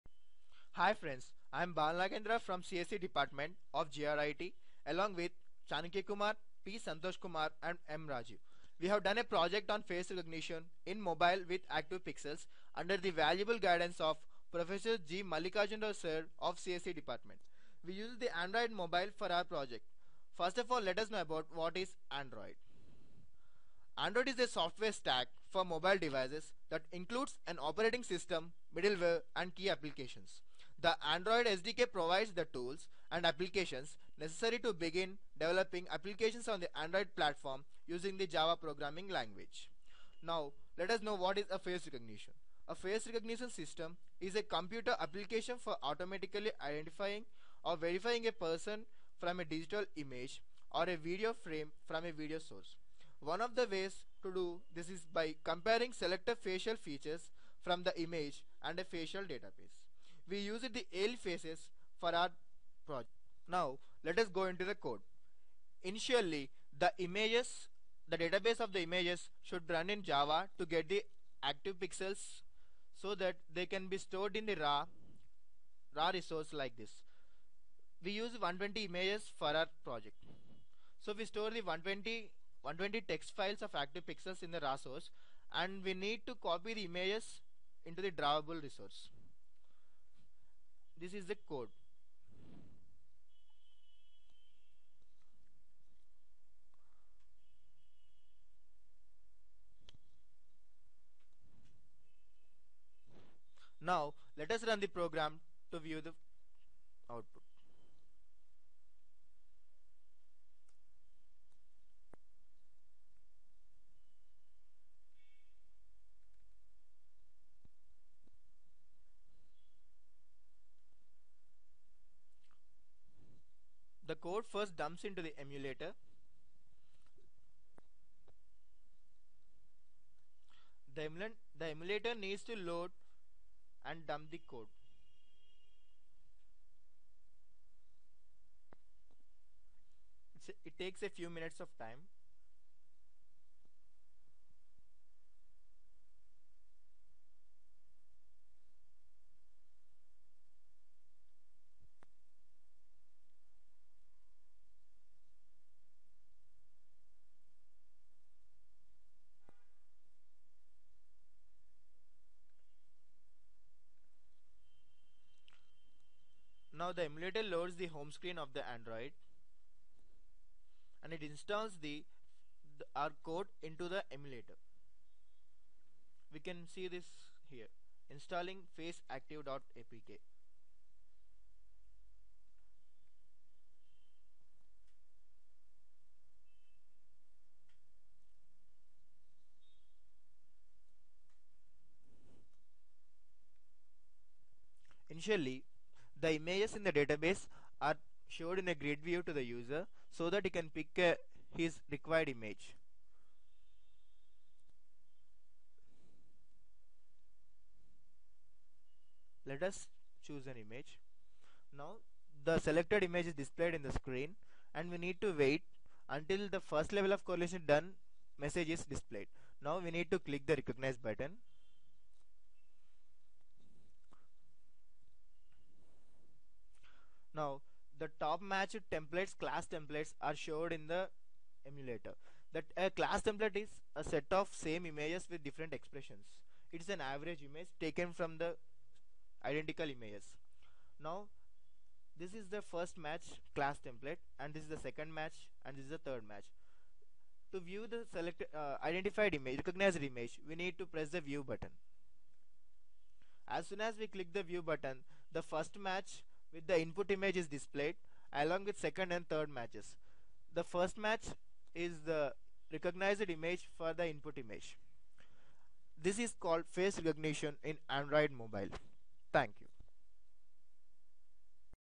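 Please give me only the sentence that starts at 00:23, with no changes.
Android is a software stack for mobile devices that includes an operating system, middleware and key applications.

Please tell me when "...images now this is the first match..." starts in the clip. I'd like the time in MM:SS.
03:59.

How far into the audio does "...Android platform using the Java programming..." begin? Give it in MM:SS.
00:36.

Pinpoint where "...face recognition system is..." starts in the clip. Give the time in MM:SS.
00:42.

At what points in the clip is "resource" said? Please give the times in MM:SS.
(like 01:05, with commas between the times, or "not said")
01:16, 01:28.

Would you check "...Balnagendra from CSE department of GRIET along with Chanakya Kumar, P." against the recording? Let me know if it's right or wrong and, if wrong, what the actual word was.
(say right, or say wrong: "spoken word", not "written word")
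right.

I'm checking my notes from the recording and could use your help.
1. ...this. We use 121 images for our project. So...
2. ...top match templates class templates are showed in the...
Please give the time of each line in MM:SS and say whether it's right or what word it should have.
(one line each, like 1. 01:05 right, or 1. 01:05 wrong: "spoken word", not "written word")
1. 01:16 wrong: "120", not "121"
2. 03:48 right.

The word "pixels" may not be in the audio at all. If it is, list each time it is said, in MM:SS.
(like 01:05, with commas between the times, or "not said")
00:12, 01:11, 01:24.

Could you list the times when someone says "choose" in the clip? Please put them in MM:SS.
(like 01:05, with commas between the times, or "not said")
03:30.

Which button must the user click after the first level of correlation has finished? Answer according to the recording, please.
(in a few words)
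Recognize.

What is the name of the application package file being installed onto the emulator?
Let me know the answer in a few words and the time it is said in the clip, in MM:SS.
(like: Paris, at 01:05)
faceactive.apk, at 02:58.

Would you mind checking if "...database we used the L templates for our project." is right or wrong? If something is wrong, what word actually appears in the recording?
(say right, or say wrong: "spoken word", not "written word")
wrong: "faces", not "templates".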